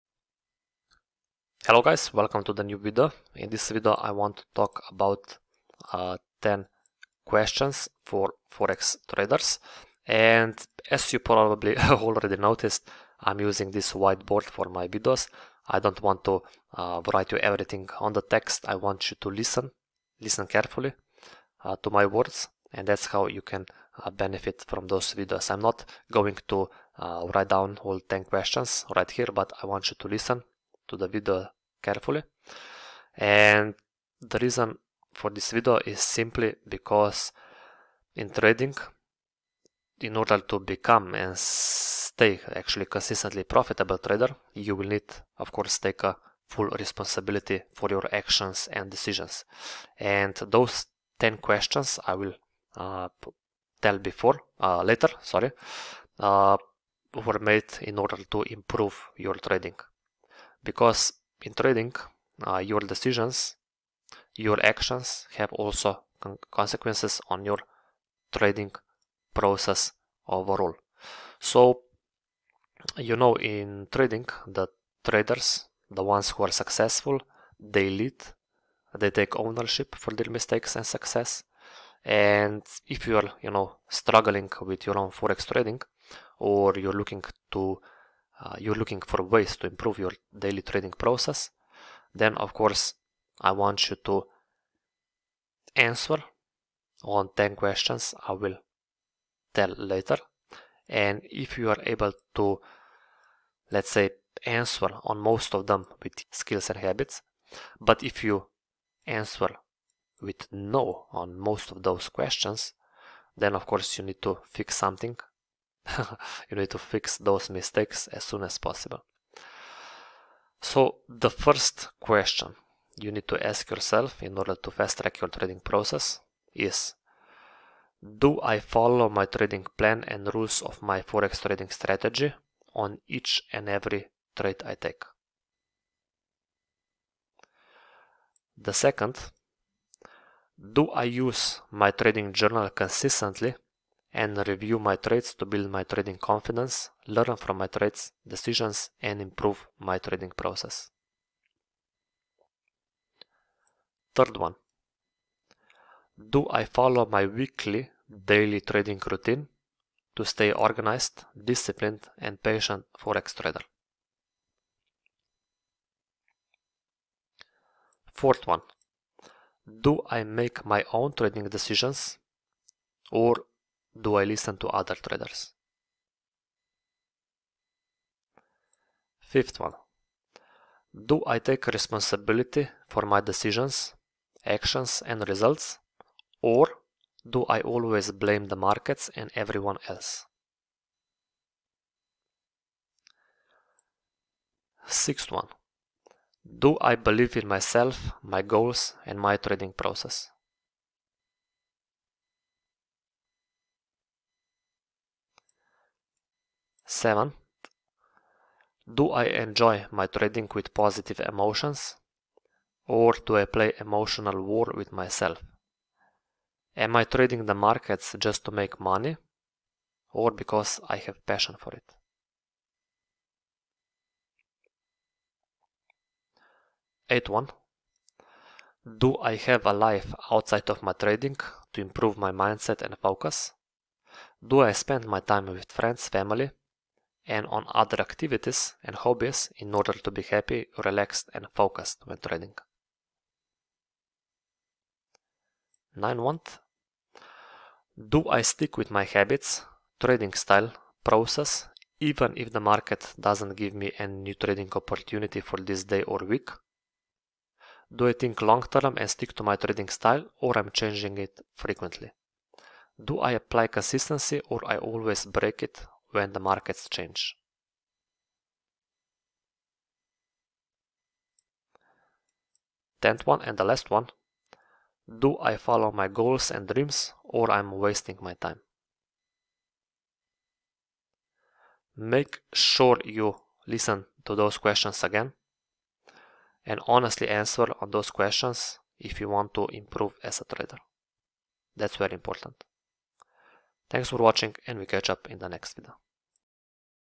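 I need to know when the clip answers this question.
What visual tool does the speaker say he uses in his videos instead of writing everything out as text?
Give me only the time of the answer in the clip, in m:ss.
0:13.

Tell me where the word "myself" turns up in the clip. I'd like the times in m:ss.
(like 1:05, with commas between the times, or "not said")
3:17, 3:34.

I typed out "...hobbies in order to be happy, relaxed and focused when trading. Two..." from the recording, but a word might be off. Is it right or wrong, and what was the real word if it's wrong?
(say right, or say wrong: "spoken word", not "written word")
wrong: "Nine", not "Two".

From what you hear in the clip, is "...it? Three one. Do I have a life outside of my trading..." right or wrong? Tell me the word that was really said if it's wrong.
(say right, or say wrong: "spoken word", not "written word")
wrong: "Eight", not "Three".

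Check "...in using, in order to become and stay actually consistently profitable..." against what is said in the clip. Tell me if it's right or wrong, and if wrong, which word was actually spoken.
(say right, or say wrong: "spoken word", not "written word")
wrong: "trading", not "using".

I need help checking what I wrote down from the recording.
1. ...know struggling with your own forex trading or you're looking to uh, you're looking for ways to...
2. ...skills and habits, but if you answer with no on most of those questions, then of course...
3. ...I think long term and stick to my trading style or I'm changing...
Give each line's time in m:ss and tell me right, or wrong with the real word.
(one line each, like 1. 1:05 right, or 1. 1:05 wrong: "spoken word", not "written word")
1. 1:23 right
2. 1:46 right
3. 4:18 right.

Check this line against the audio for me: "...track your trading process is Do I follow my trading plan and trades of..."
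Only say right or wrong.
wrong.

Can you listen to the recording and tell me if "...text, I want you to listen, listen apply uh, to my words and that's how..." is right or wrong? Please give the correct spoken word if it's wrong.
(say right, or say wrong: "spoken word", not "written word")
wrong: "carefully", not "apply".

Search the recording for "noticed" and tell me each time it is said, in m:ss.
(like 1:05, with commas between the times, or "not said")
0:12.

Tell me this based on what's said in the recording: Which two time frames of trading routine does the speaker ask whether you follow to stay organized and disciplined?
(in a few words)
Weekly, daily.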